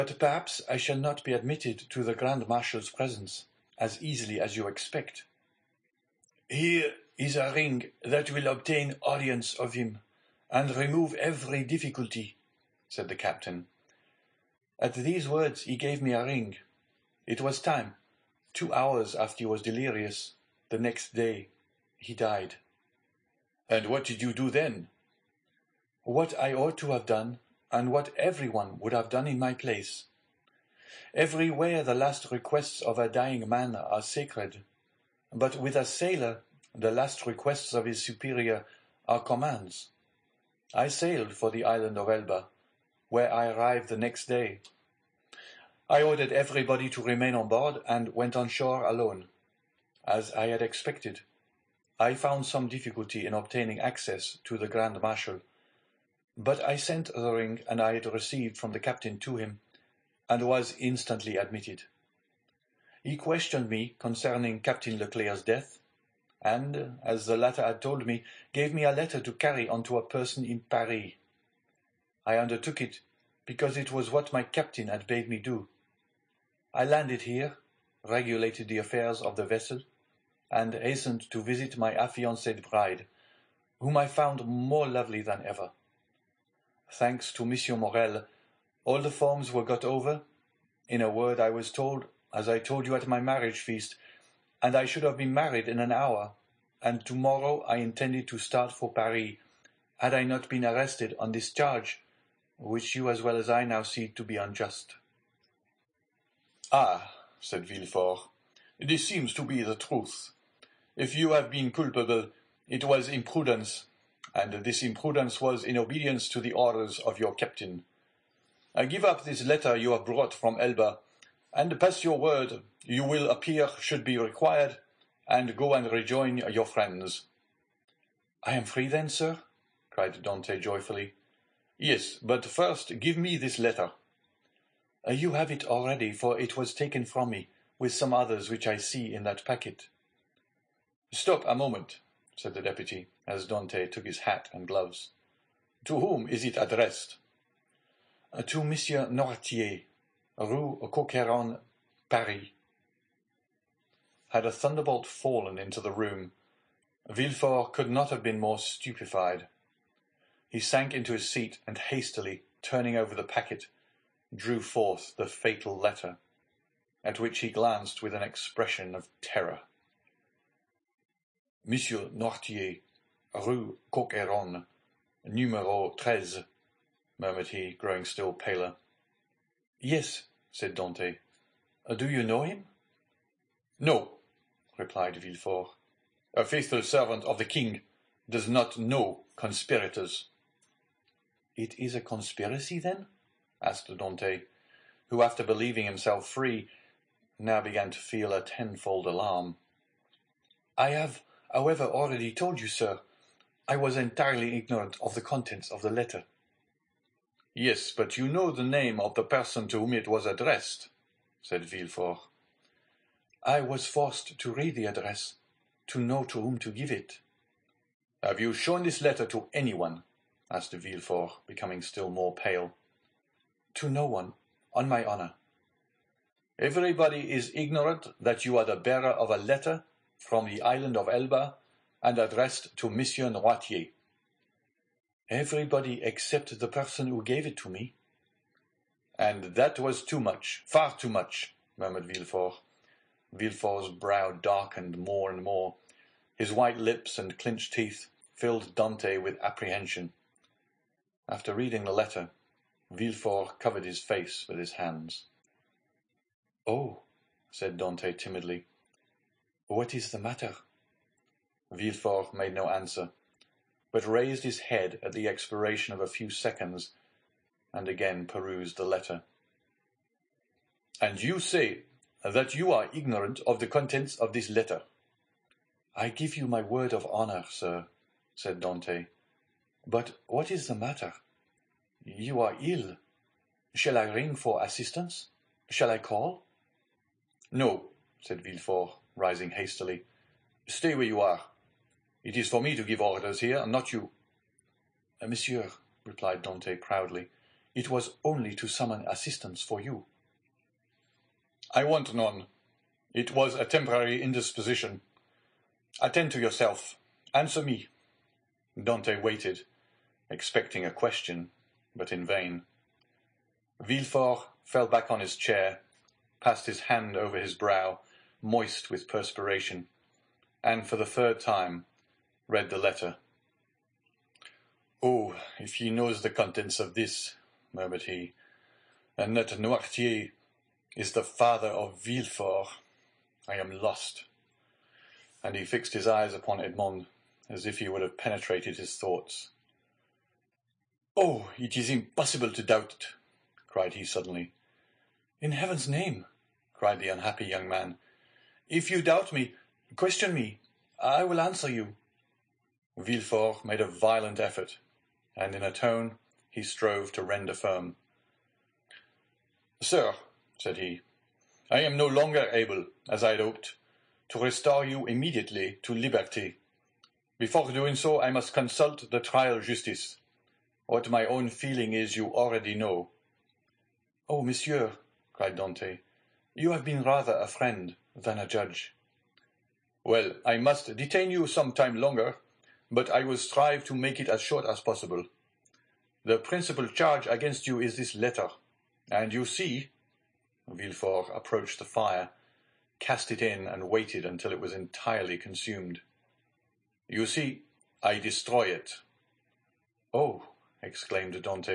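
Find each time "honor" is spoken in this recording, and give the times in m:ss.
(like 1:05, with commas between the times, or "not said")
3:45, 4:37.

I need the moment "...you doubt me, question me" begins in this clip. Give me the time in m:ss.
5:48.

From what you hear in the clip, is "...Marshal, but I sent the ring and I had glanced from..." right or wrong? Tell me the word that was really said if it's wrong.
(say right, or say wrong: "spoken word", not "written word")
wrong: "received", not "glanced".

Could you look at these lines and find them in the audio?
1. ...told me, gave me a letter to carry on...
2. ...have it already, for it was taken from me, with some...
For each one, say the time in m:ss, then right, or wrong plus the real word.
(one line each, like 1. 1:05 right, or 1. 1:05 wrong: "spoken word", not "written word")
1. 1:07 right
2. 2:15 right.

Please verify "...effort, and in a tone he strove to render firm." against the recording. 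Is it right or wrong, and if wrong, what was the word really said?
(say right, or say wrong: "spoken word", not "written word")
right.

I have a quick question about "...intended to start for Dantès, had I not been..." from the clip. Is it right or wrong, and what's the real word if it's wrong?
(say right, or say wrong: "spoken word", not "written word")
wrong: "Paris", not "Dantès".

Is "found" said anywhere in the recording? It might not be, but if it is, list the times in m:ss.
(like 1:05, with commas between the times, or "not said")
0:52, 1:24.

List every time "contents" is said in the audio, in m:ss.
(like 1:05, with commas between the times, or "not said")
3:25, 4:33, 5:26.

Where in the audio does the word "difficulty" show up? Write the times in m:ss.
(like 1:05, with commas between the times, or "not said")
0:11, 0:52.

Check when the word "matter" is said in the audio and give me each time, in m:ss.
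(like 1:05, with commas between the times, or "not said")
4:20, 4:40.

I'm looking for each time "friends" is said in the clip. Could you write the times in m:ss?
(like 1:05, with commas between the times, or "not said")
2:06, 6:17.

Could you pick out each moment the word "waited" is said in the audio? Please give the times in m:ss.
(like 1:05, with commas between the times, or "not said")
5:09, 6:33.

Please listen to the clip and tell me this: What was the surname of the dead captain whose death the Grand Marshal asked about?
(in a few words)
Leclerc.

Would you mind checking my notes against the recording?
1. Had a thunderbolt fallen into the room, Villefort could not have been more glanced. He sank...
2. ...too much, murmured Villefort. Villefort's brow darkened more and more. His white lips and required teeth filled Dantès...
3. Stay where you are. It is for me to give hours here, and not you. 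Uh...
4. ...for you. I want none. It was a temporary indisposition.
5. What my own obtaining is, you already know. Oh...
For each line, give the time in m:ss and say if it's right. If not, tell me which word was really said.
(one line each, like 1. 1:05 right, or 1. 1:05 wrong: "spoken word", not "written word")
1. 2:34 wrong: "stupefied", not "glanced"
2. 4:00 wrong: "clenched", not "required"
3. 4:50 wrong: "orders", not "hours"
4. 4:59 right
5. 6:10 wrong: "feeling", not "obtaining".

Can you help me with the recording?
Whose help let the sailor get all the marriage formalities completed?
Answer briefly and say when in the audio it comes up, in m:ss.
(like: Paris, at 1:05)
Monsieur Morrel, at 1:27.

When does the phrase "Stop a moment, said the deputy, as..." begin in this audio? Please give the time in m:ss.
2:21.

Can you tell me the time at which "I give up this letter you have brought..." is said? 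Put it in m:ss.
1:58.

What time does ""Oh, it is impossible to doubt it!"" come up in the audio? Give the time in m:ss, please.
5:41.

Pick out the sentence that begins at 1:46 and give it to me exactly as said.
Ah, said Villefort, this seems to be the truth.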